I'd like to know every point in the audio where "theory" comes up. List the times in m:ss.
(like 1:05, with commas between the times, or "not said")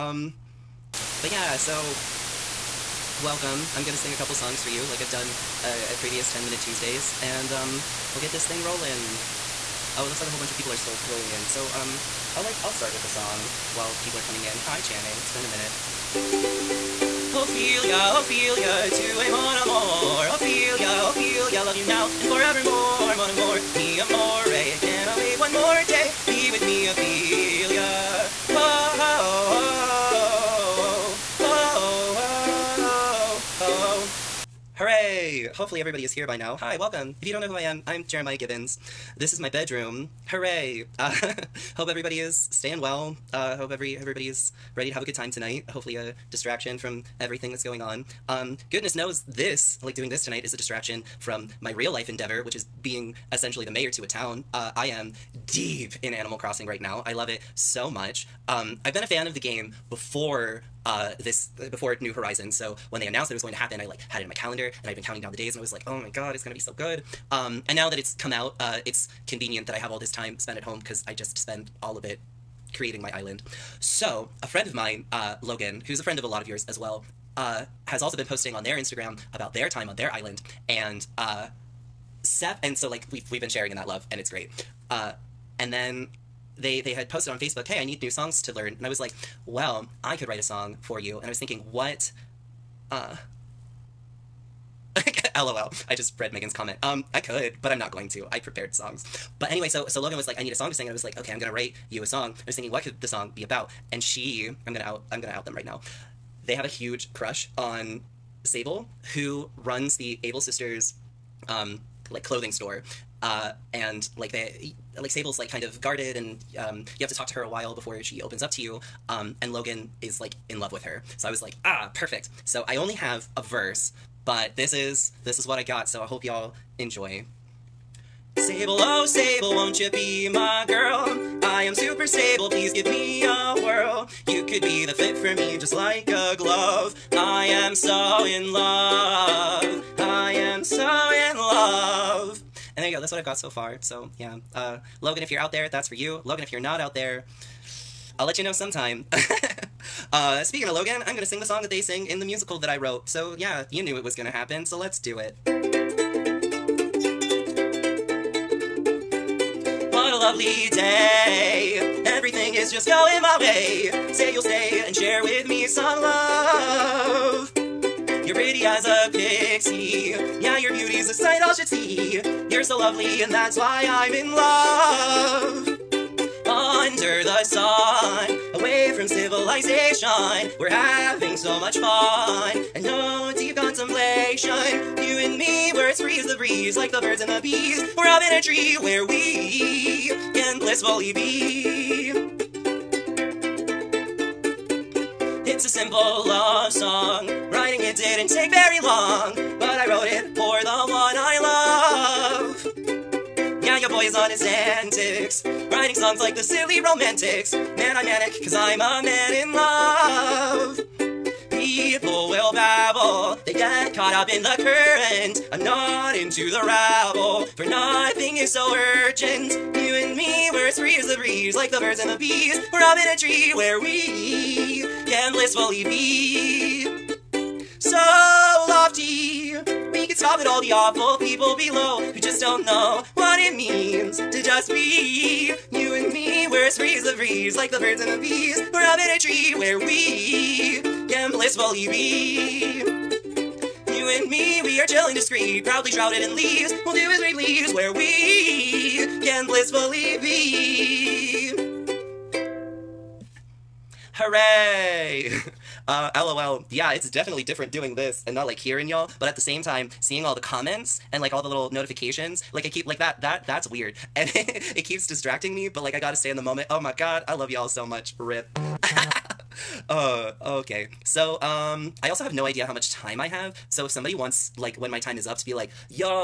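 not said.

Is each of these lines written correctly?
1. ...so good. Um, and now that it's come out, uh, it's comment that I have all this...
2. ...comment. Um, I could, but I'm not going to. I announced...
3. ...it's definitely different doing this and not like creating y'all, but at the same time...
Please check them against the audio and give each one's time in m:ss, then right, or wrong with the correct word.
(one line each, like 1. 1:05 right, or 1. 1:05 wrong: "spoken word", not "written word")
1. 1:06 wrong: "convenient", not "comment"
2. 1:36 wrong: "prepared", not "announced"
3. 4:16 wrong: "hearing", not "creating".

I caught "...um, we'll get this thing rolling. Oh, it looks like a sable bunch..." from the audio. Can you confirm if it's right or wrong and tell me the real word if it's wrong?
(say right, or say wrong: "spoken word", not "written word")
wrong: "whole", not "sable".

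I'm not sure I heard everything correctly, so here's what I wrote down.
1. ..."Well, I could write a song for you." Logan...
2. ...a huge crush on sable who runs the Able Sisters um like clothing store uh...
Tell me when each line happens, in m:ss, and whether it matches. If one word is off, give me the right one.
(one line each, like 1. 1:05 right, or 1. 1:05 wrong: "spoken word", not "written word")
1. 1:29 wrong: "And", not "Logan"
2. 1:46 right.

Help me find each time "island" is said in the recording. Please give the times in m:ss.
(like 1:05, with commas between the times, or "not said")
1:13, 1:20.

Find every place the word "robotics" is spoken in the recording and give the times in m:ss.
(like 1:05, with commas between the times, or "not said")
not said.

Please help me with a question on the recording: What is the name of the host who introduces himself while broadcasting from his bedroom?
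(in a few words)
Jeremiah Gibbons.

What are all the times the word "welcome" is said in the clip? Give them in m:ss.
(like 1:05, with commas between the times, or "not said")
0:03, 0:36.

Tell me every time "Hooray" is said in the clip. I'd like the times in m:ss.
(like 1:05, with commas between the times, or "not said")
0:40, 4:14.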